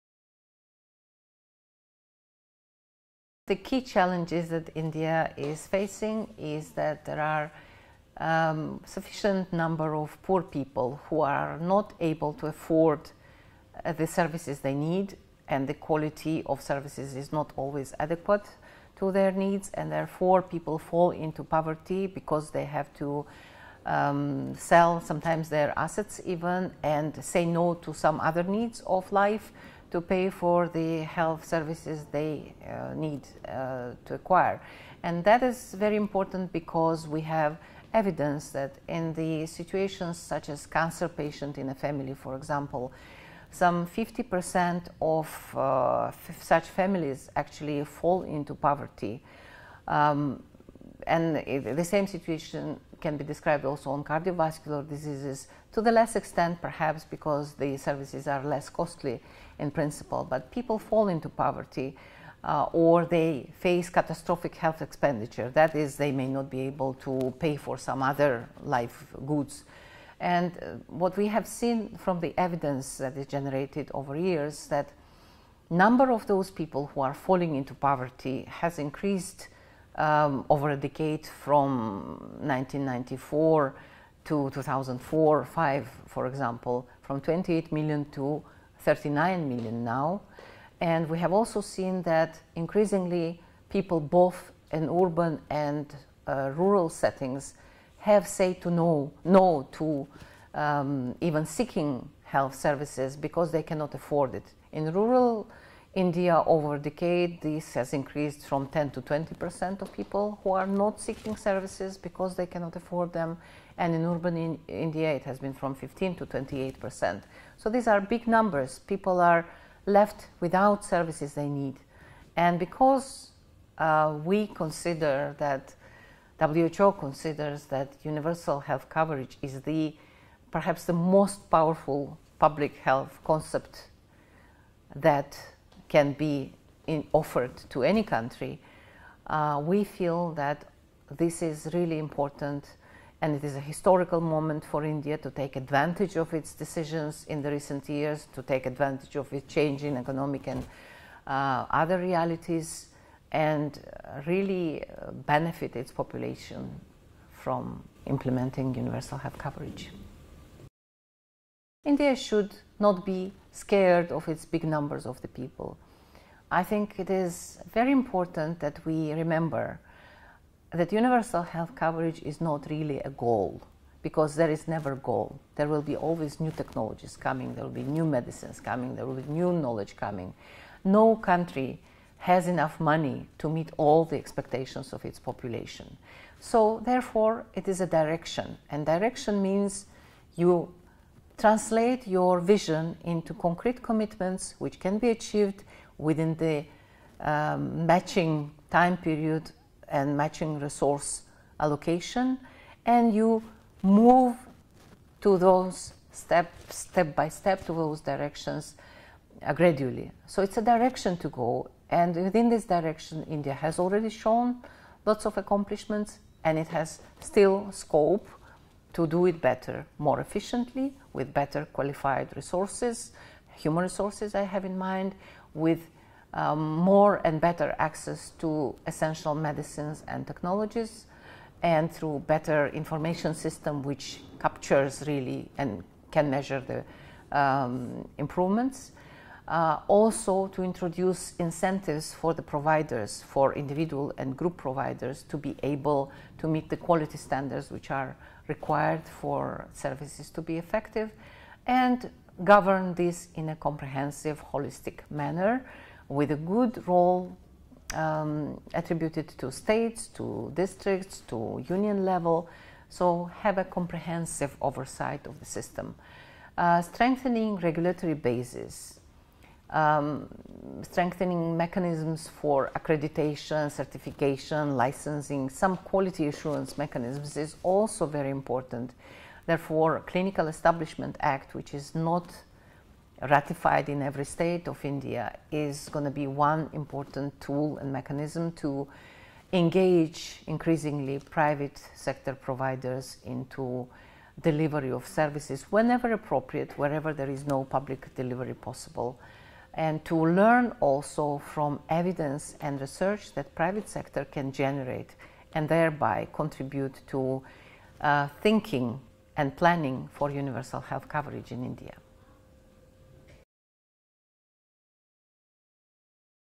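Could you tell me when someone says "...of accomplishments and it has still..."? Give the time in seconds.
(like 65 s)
215 s.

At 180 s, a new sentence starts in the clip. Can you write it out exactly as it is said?
No country has enough money to meet all the expectations of its population.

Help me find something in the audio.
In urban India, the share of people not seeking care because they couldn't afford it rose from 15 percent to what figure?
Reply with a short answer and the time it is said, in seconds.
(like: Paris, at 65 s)
28 percent, at 116 s.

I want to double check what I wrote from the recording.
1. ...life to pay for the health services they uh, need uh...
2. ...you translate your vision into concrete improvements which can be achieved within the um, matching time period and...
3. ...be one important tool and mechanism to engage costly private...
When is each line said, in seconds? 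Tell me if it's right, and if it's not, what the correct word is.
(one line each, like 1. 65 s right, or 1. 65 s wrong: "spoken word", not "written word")
1. 29 s right
2. 190 s wrong: "commitments", not "improvements"
3. 286 s wrong: "increasingly", not "costly".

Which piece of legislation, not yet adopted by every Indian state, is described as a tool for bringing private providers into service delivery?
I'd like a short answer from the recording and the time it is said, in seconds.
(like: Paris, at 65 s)
Clinical Establishment Act, at 280 s.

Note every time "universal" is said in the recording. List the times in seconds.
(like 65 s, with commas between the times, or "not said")
128 s, 158 s, 170 s, 310 s.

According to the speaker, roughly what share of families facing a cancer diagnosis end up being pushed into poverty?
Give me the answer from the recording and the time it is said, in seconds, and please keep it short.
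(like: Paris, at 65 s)
50%, at 43 s.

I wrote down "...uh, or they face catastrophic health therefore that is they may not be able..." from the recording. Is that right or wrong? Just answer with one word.
wrong.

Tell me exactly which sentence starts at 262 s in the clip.
So have a comprehensive oversight of the system.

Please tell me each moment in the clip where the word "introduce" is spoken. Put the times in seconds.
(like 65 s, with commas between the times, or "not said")
240 s.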